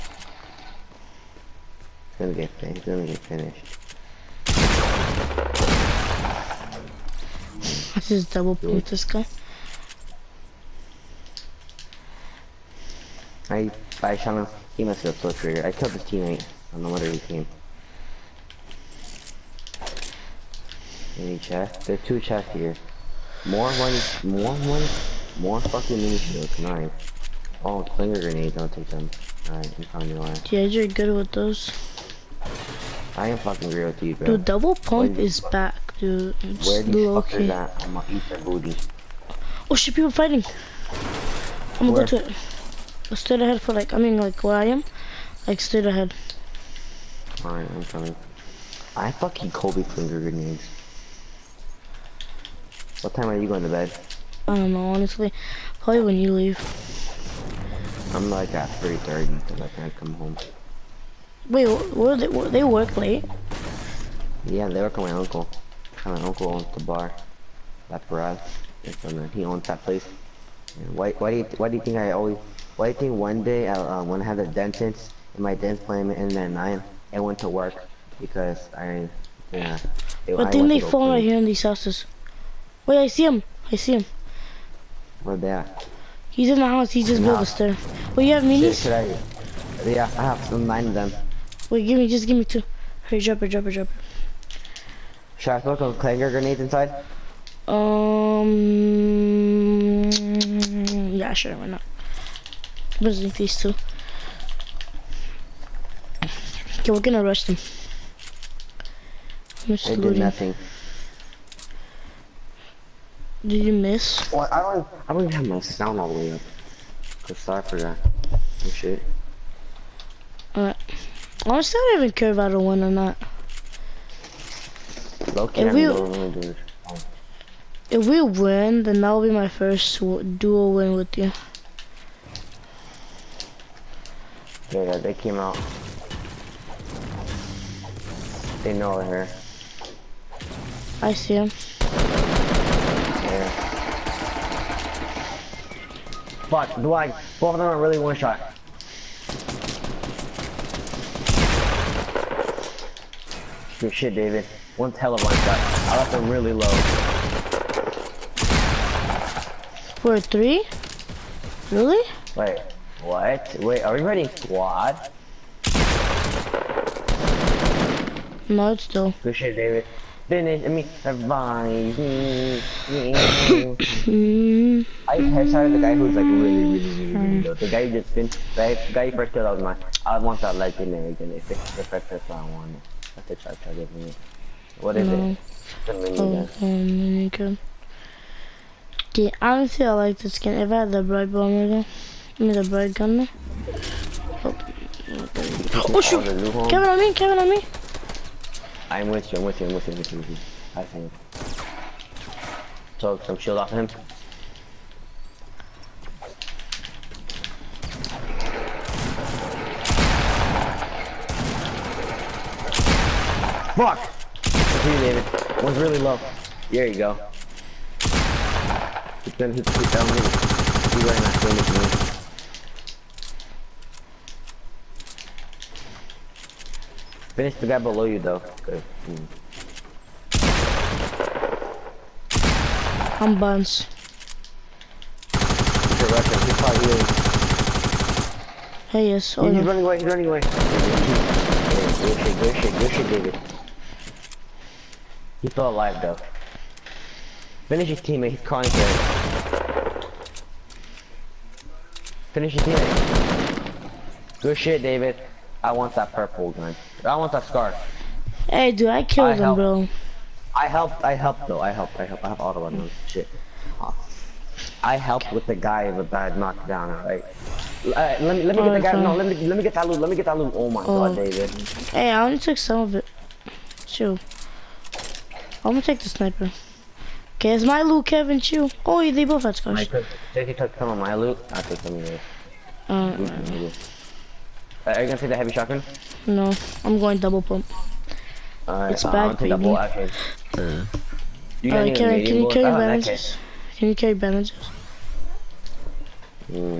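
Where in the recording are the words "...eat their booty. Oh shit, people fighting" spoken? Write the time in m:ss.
0:38.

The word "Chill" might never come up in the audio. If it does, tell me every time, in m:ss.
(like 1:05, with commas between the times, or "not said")
4:33, 4:38.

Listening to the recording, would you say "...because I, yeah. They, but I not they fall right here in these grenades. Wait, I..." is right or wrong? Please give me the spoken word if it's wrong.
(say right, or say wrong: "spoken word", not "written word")
wrong: "houses", not "grenades".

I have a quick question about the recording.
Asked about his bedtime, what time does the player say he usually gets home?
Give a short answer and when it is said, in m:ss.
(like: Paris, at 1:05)
3:30, at 0:58.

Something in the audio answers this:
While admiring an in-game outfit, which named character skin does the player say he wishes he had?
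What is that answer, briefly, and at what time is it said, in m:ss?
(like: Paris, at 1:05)
Brite Bomber, at 3:11.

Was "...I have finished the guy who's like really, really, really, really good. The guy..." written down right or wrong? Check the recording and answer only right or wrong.
wrong.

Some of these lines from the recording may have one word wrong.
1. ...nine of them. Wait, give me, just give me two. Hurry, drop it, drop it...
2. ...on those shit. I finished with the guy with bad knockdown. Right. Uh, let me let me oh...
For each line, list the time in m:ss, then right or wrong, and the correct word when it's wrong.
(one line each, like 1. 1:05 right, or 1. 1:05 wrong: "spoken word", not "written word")
1. 1:30 right
2. 4:22 wrong: "helped", not "finished".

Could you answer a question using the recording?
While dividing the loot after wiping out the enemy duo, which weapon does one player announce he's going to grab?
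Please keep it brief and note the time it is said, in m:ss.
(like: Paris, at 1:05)
Sniper, at 4:36.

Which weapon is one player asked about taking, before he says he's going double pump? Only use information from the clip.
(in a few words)
Heavy shotgun.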